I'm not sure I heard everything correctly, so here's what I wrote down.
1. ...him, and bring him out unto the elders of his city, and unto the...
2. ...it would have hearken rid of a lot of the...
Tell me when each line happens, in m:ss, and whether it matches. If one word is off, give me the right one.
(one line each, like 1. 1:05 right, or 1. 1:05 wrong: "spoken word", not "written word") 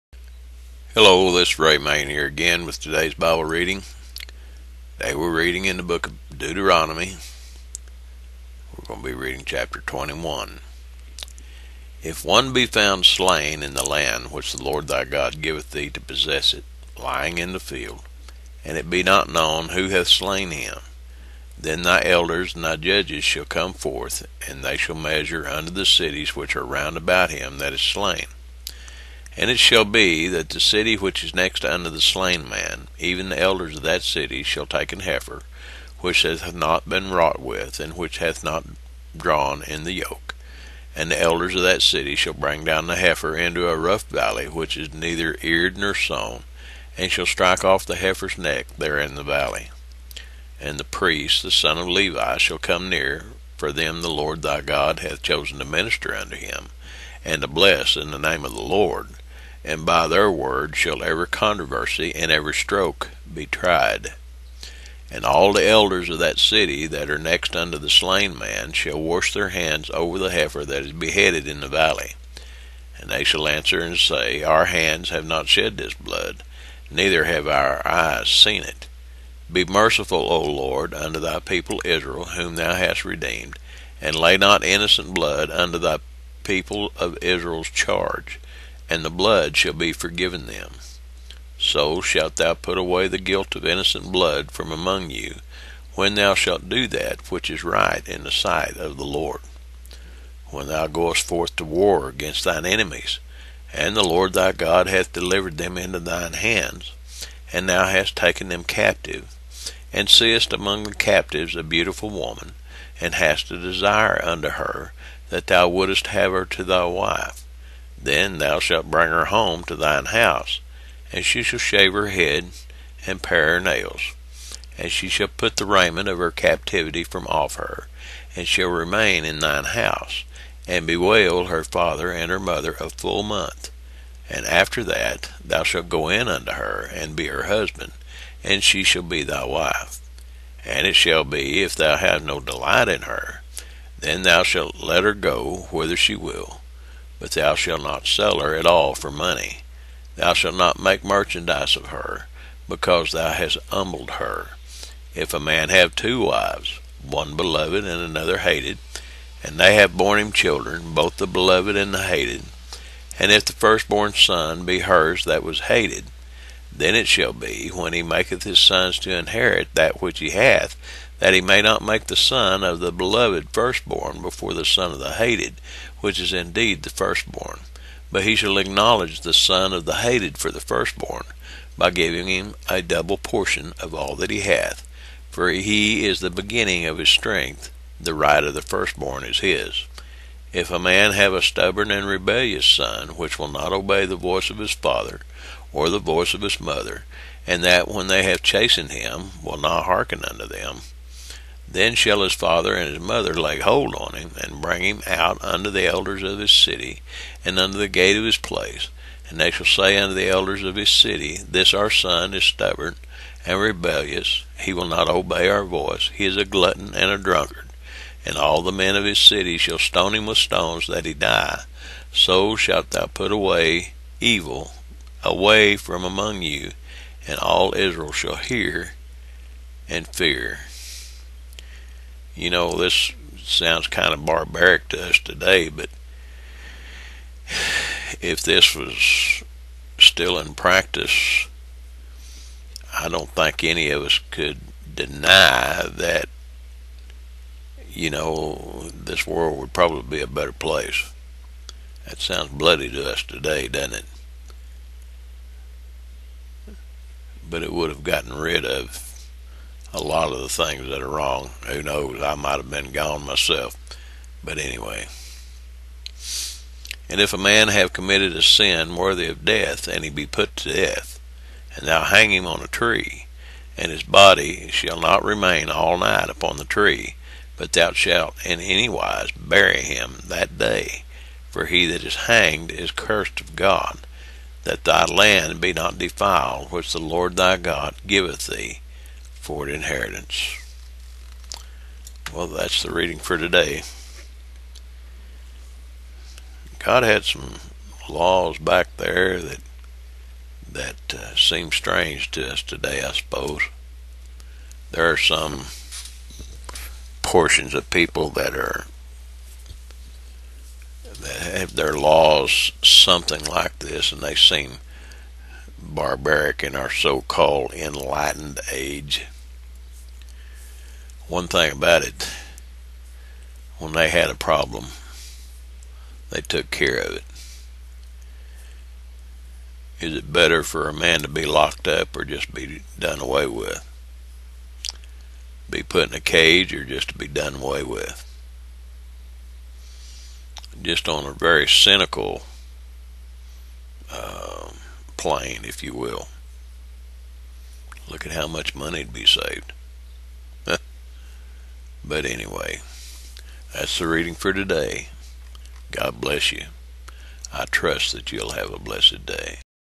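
1. 3:24 right
2. 4:17 wrong: "gotten", not "hearken".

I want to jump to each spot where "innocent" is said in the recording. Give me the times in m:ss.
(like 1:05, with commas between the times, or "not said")
1:24, 1:33.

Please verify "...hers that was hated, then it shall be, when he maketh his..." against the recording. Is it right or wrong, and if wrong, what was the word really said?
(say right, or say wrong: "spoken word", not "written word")
right.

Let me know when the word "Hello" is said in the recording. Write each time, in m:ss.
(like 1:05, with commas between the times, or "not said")
0:00.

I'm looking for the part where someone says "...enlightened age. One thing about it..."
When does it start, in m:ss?
5:17.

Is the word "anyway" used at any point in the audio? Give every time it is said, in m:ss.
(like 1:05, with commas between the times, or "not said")
4:24, 5:52.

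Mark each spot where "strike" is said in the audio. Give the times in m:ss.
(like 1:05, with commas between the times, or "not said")
0:47.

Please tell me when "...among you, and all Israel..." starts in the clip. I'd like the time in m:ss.
3:46.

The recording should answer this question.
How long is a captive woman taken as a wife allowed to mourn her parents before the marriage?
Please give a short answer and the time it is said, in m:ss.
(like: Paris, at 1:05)
A full month, at 2:12.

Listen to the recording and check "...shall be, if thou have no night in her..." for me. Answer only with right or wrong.
wrong.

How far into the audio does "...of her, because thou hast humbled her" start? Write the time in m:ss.
2:31.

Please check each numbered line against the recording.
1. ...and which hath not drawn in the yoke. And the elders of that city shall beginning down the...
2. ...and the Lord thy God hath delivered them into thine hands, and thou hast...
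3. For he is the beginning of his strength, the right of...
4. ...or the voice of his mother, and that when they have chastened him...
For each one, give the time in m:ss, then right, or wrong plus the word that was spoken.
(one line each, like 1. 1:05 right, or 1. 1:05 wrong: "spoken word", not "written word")
1. 0:37 wrong: "bring", not "beginning"
2. 1:43 right
3. 3:05 right
4. 3:15 right.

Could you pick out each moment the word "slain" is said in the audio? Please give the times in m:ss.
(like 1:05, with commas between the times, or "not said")
0:13, 0:20, 0:27, 0:32, 1:07.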